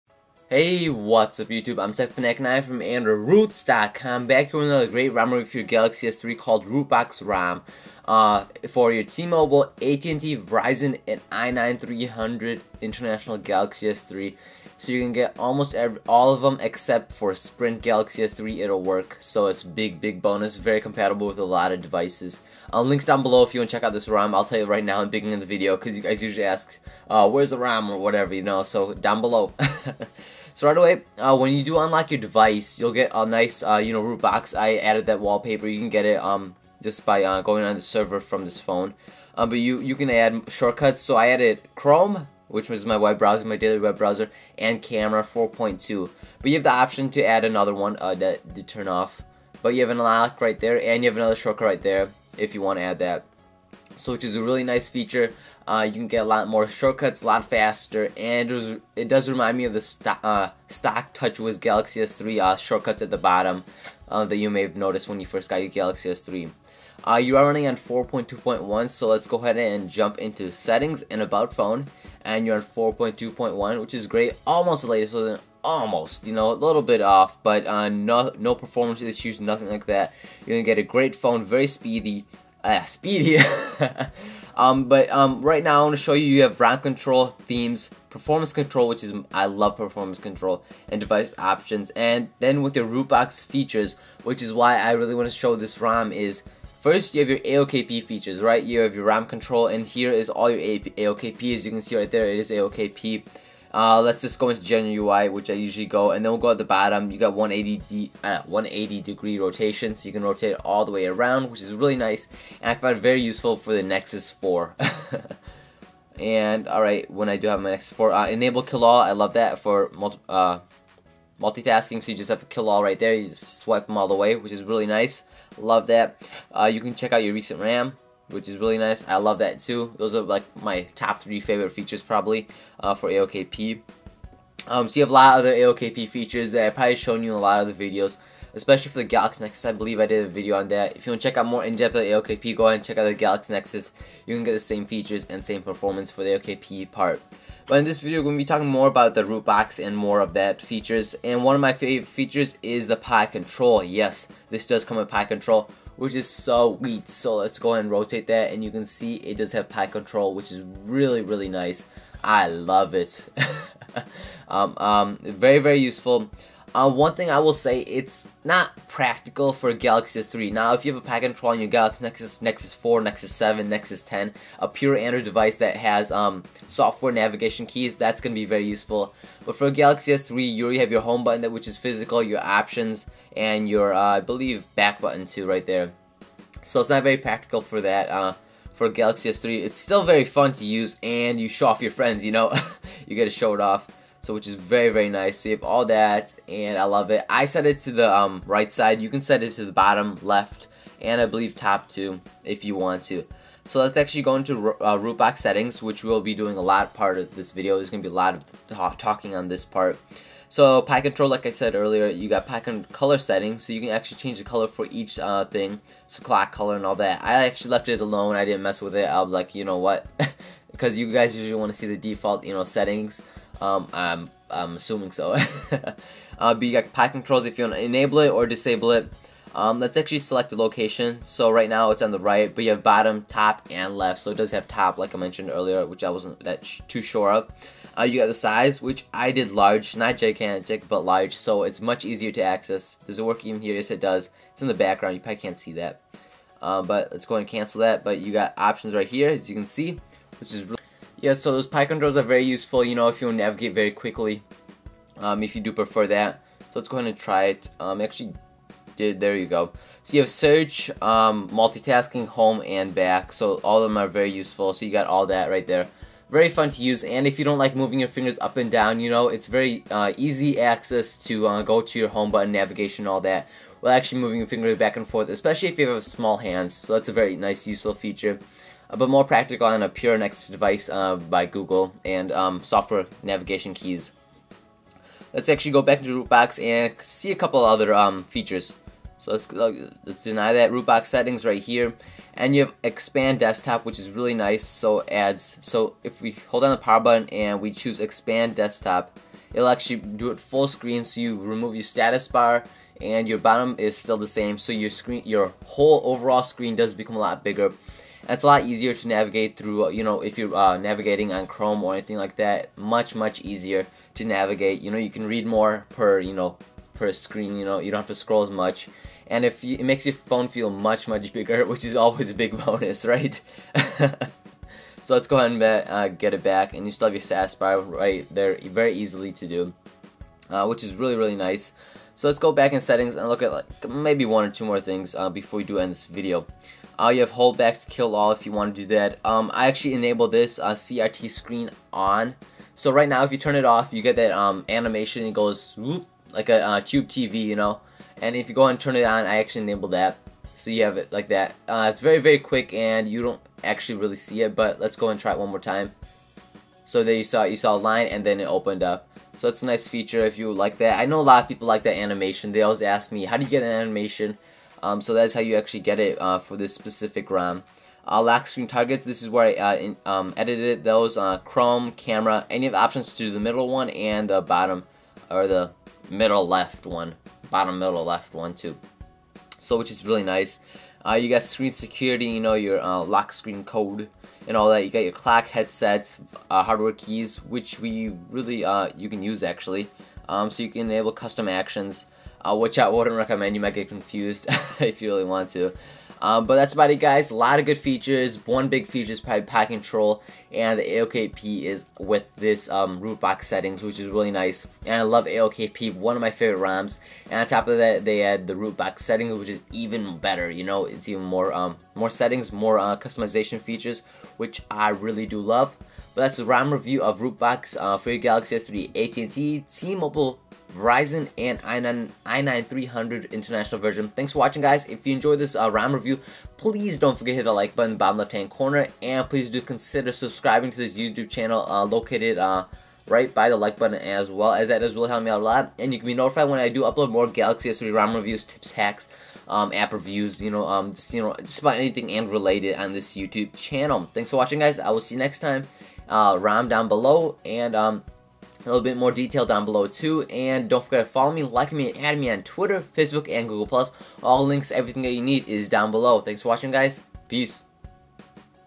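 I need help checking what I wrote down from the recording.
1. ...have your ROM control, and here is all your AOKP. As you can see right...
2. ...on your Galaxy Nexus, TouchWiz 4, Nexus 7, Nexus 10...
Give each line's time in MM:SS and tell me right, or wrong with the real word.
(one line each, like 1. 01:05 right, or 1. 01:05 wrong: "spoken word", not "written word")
1. 01:38 right
2. 02:51 wrong: "Nexus", not "TouchWiz".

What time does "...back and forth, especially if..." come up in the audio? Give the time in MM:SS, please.
04:34.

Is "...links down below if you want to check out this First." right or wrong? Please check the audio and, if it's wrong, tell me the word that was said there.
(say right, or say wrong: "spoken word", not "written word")
wrong: "ROM", not "First".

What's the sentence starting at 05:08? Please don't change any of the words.
It's a lot easier to navigate through, uh, you know, if you're uh, navigating on Chrome or anything like that.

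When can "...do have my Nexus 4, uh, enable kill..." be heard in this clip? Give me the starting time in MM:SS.
01:57.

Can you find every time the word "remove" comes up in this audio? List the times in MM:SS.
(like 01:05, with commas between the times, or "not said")
05:01.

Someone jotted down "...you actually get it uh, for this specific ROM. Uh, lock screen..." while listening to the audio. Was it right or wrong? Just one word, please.
right.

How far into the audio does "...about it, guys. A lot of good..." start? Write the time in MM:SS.
06:36.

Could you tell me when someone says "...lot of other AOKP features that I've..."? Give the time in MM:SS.
02:15.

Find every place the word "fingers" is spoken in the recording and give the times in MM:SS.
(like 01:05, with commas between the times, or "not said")
04:28, 04:34.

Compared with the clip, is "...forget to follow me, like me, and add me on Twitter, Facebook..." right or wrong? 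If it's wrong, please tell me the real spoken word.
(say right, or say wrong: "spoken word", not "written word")
right.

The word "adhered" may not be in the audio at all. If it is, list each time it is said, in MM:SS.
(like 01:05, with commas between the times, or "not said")
not said.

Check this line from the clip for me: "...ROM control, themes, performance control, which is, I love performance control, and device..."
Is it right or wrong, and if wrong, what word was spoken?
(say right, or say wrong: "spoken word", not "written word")
right.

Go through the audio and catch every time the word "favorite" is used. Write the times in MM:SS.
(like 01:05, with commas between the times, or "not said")
02:11, 02:31, 06:46.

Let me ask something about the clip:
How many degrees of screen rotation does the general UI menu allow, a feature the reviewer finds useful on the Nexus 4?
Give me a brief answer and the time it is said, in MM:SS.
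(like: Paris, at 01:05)
180, at 01:48.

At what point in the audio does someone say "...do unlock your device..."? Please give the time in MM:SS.
00:31.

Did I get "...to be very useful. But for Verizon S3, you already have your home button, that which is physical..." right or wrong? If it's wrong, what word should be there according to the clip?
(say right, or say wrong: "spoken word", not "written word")
wrong: "Galaxy", not "Verizon".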